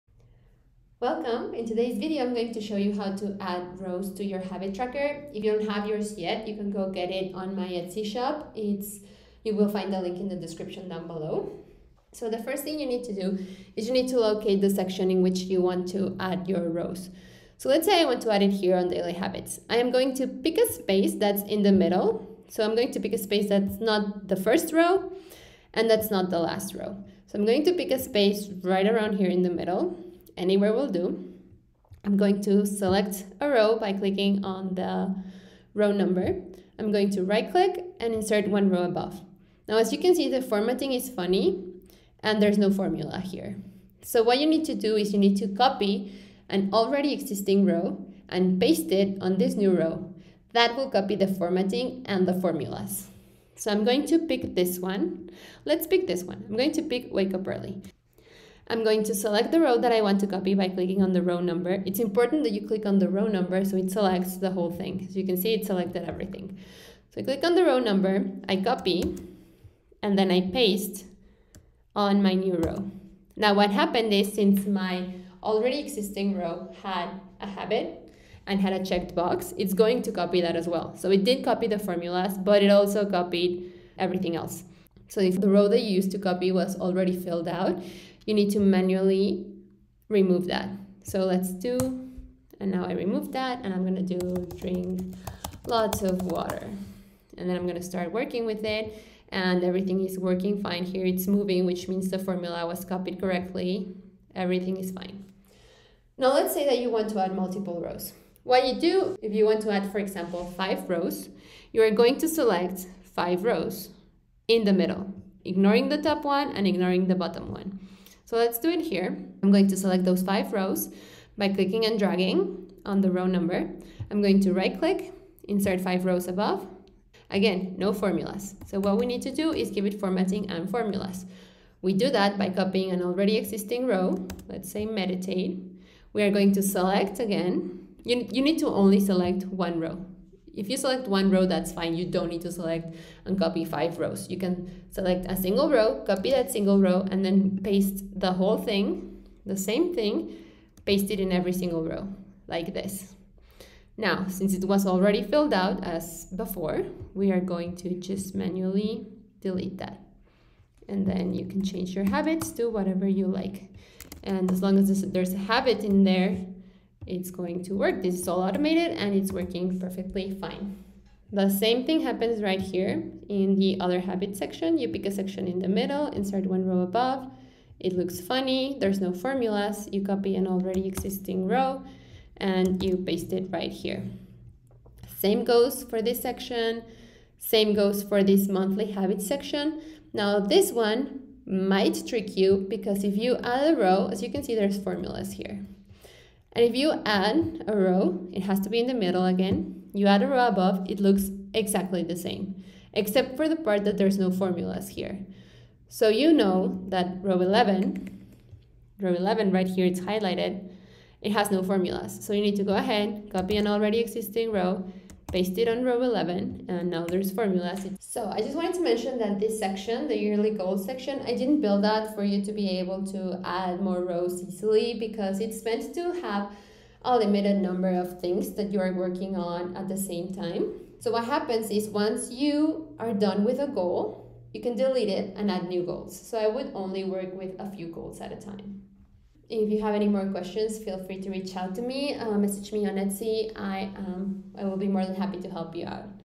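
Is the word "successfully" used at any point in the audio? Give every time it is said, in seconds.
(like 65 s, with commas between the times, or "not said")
not said.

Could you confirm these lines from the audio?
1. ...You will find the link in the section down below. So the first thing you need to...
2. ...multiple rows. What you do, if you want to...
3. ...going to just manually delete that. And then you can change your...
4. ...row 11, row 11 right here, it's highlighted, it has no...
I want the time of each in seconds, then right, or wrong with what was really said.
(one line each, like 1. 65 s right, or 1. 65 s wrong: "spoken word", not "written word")
1. 9 s wrong: "description", not "section"
2. 107 s right
3. 157 s right
4. 207 s right.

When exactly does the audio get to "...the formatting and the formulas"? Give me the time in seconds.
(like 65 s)
51 s.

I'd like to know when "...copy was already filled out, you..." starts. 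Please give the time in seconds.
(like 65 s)
86 s.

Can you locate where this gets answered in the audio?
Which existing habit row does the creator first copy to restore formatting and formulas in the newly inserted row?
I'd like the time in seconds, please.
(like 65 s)
57 s.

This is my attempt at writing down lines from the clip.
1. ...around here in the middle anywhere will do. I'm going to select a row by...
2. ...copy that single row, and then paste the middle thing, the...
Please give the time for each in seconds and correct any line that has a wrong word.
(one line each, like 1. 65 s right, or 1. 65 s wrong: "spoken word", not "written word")
1. 28 s right
2. 146 s wrong: "whole", not "middle".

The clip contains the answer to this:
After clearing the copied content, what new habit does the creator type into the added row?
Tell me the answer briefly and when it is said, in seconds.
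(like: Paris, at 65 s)
drink lots of water, at 94 s.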